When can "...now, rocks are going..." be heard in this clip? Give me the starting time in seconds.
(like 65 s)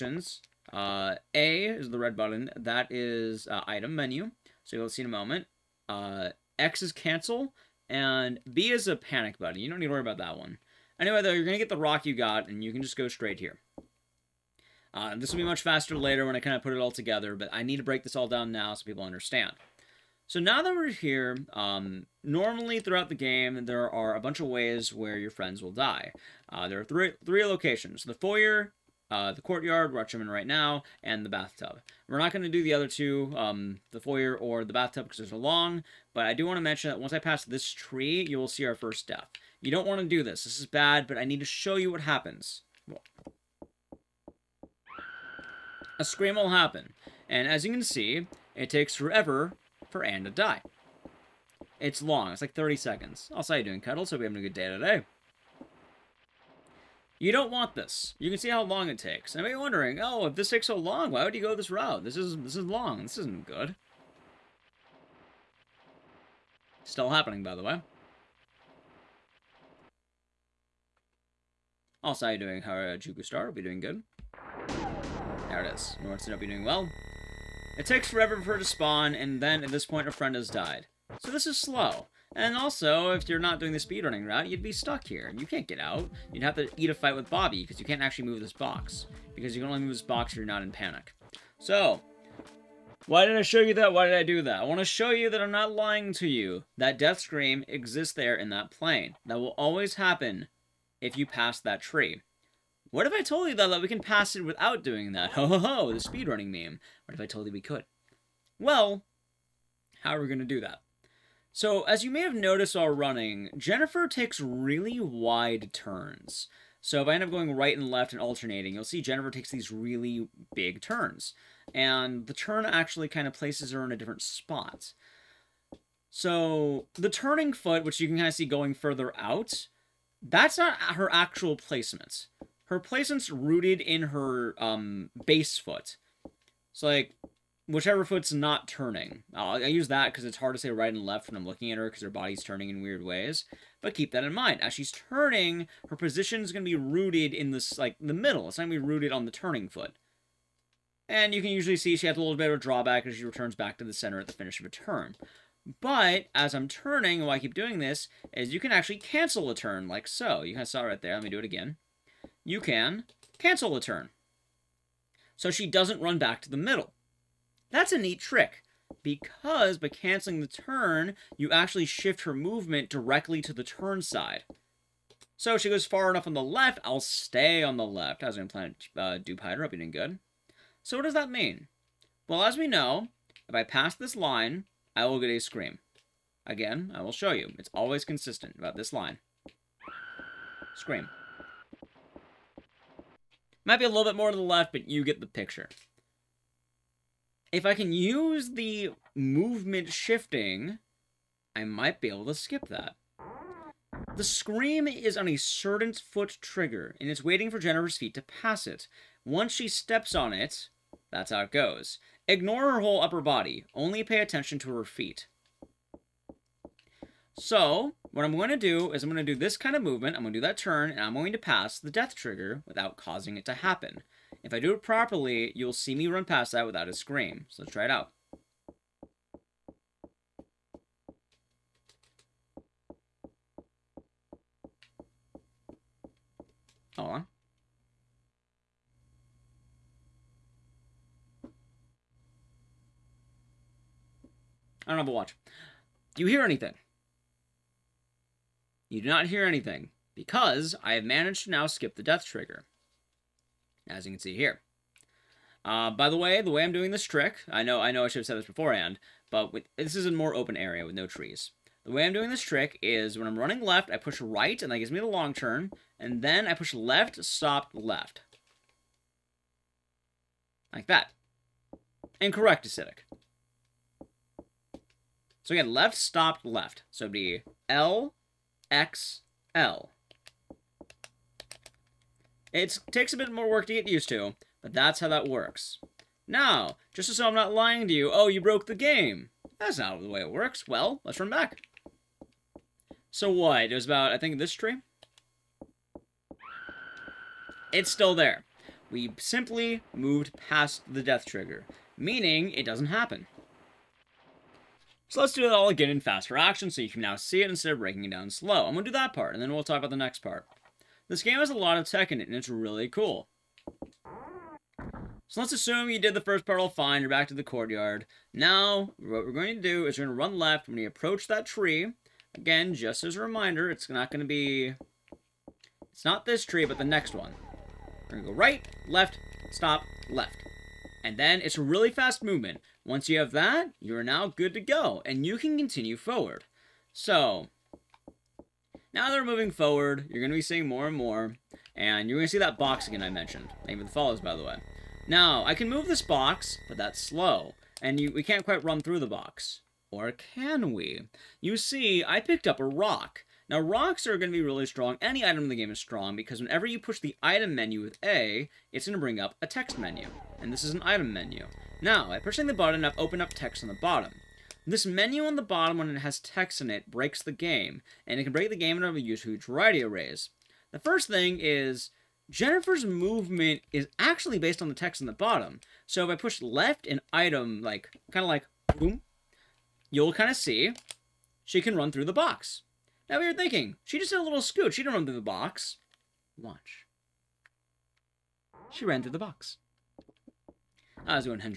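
353 s.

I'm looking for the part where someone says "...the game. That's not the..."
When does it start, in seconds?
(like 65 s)
288 s.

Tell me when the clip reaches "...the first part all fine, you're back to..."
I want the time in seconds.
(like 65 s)
316 s.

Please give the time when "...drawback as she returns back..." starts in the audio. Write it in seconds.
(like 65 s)
152 s.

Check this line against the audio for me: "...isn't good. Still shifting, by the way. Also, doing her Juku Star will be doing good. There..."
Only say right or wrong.
wrong.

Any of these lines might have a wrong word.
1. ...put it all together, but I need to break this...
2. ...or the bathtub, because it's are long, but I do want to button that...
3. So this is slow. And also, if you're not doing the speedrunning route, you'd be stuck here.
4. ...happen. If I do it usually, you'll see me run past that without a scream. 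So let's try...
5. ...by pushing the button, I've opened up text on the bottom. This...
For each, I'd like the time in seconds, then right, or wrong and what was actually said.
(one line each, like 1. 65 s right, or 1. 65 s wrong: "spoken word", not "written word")
1. 16 s right
2. 34 s wrong: "mention", not "button"
3. 81 s right
4. 223 s wrong: "properly", not "usually"
5. 362 s right.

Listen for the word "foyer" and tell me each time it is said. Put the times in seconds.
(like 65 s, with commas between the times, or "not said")
28 s, 33 s.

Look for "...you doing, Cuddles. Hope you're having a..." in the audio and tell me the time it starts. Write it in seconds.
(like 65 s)
53 s.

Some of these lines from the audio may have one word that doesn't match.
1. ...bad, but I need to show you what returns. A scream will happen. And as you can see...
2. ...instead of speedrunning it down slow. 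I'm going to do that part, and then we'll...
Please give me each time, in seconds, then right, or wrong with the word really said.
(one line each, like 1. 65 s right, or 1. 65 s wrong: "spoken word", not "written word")
1. 40 s wrong: "happens", not "returns"
2. 307 s wrong: "breaking", not "speedrunning".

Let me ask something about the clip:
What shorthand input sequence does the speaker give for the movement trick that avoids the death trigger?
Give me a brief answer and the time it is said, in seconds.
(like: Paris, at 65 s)
L, X, L, at 277 s.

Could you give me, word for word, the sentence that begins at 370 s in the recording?
The first thing is Jennifer's movement is actually based on the text on the bottom.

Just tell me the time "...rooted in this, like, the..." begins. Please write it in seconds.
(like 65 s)
146 s.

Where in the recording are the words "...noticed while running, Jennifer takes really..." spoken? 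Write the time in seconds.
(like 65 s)
112 s.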